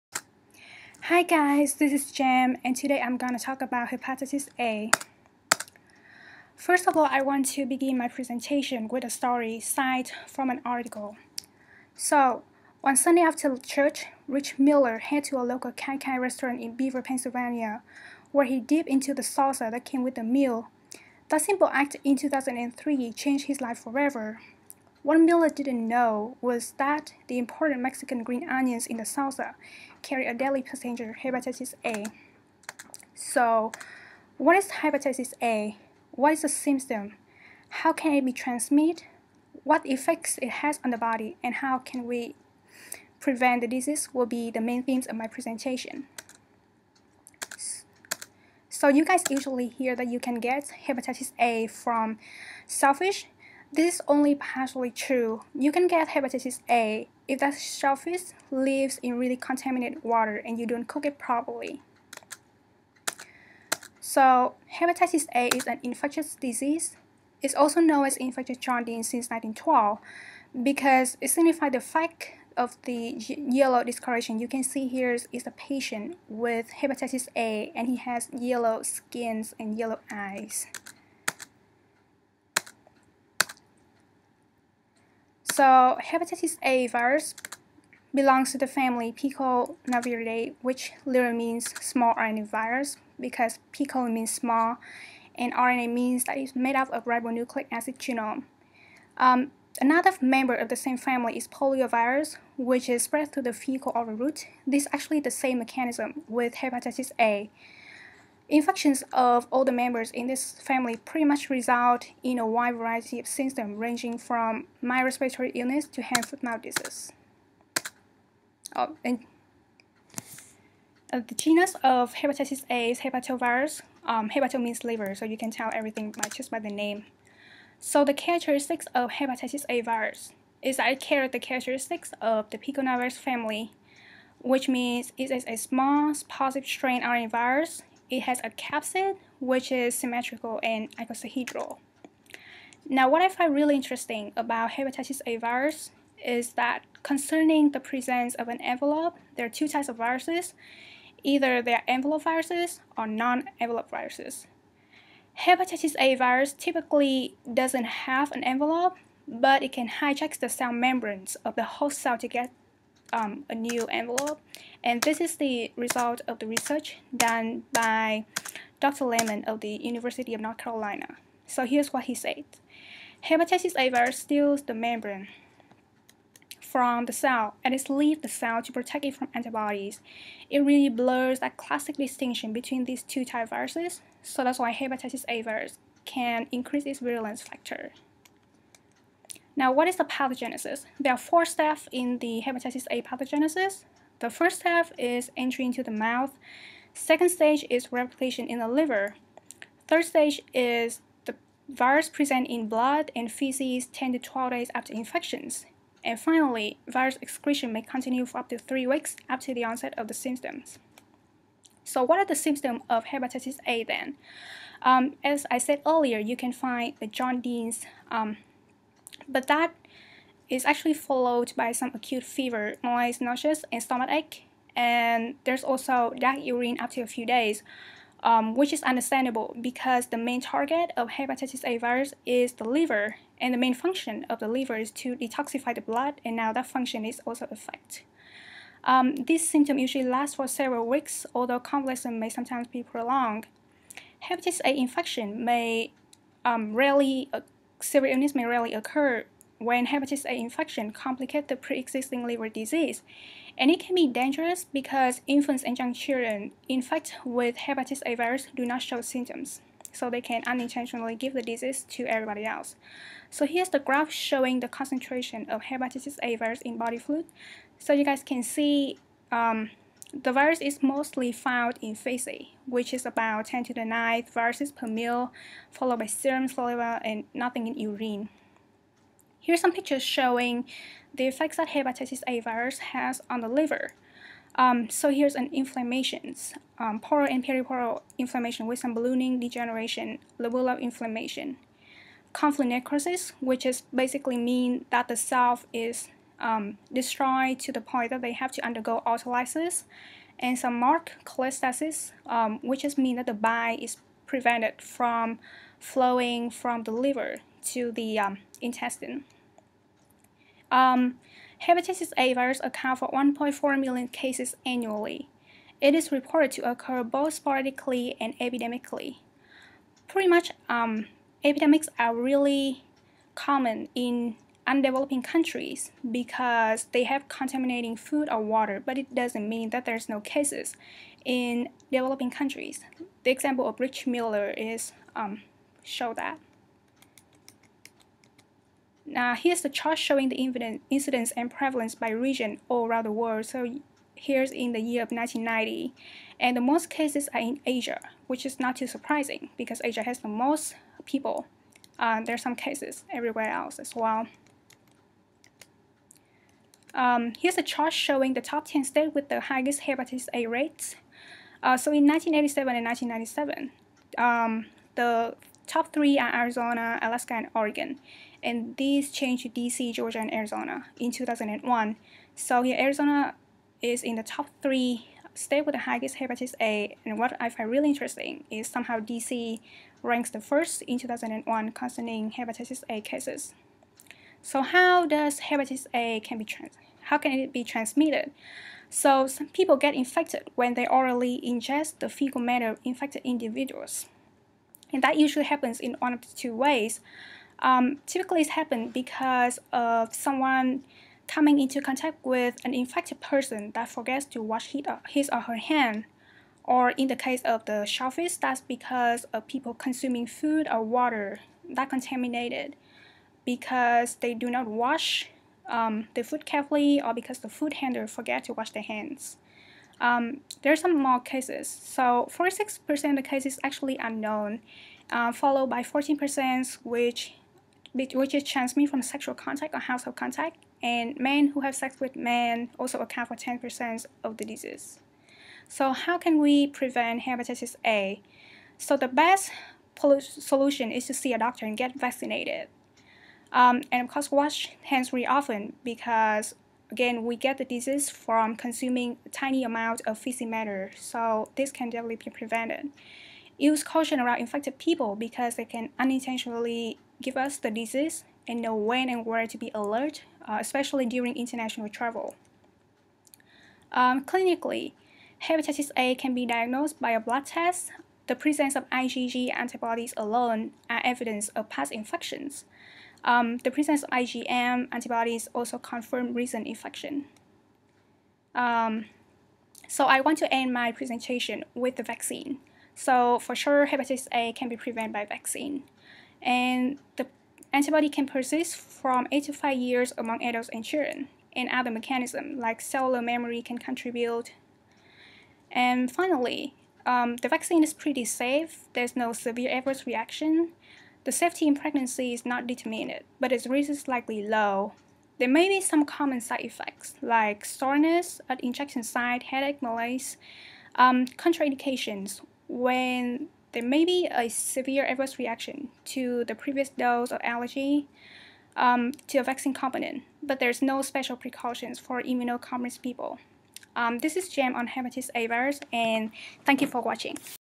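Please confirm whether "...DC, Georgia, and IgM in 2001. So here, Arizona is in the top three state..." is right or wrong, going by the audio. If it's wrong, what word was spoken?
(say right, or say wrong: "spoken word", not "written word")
wrong: "Arizona", not "IgM".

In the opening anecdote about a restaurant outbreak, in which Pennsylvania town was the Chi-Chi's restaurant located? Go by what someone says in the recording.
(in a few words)
Beaver.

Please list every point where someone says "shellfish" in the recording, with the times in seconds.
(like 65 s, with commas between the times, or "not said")
57 s, 407 s.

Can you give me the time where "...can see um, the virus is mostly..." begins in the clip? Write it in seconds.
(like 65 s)
268 s.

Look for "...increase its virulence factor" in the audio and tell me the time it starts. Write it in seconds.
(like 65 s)
186 s.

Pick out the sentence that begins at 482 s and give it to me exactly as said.
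So for sure, hepatitis A can be prevented by vaccine.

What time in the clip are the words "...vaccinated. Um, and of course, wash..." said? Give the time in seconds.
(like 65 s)
441 s.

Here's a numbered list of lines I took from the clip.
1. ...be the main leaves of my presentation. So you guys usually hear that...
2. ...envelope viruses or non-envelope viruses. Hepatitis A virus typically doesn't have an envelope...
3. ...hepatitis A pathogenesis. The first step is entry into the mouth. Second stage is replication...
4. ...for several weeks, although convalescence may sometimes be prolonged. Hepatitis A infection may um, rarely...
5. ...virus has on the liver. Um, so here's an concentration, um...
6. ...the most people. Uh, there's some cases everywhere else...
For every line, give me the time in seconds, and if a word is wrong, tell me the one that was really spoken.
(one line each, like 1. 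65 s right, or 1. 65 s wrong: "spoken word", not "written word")
1. 44 s wrong: "themes", not "leaves"
2. 151 s right
3. 192 s right
4. 240 s right
5. 282 s wrong: "inflammation", not "concentration"
6. 350 s right.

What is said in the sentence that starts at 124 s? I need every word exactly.
Um, hepato means liver, so you can tell everything by just by the name.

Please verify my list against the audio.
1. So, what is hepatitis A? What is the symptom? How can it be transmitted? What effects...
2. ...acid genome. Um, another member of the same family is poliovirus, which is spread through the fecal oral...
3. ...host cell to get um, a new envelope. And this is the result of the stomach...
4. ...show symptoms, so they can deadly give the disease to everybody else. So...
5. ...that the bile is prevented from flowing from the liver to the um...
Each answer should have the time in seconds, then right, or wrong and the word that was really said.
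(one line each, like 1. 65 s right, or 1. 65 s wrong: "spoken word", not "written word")
1. 33 s right
2. 97 s right
3. 161 s wrong: "research", not "stomach"
4. 258 s wrong: "unintentionally", not "deadly"
5. 303 s right.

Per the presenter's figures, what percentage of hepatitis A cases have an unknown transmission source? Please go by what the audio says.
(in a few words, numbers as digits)
46%.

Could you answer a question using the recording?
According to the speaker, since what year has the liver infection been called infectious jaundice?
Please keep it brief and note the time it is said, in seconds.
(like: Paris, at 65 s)
1912, at 69 s.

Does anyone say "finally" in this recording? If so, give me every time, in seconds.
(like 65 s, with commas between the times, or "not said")
206 s, 496 s.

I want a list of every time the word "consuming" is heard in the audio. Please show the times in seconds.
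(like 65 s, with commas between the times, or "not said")
409 s, 448 s.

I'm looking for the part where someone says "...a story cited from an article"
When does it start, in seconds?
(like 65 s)
9 s.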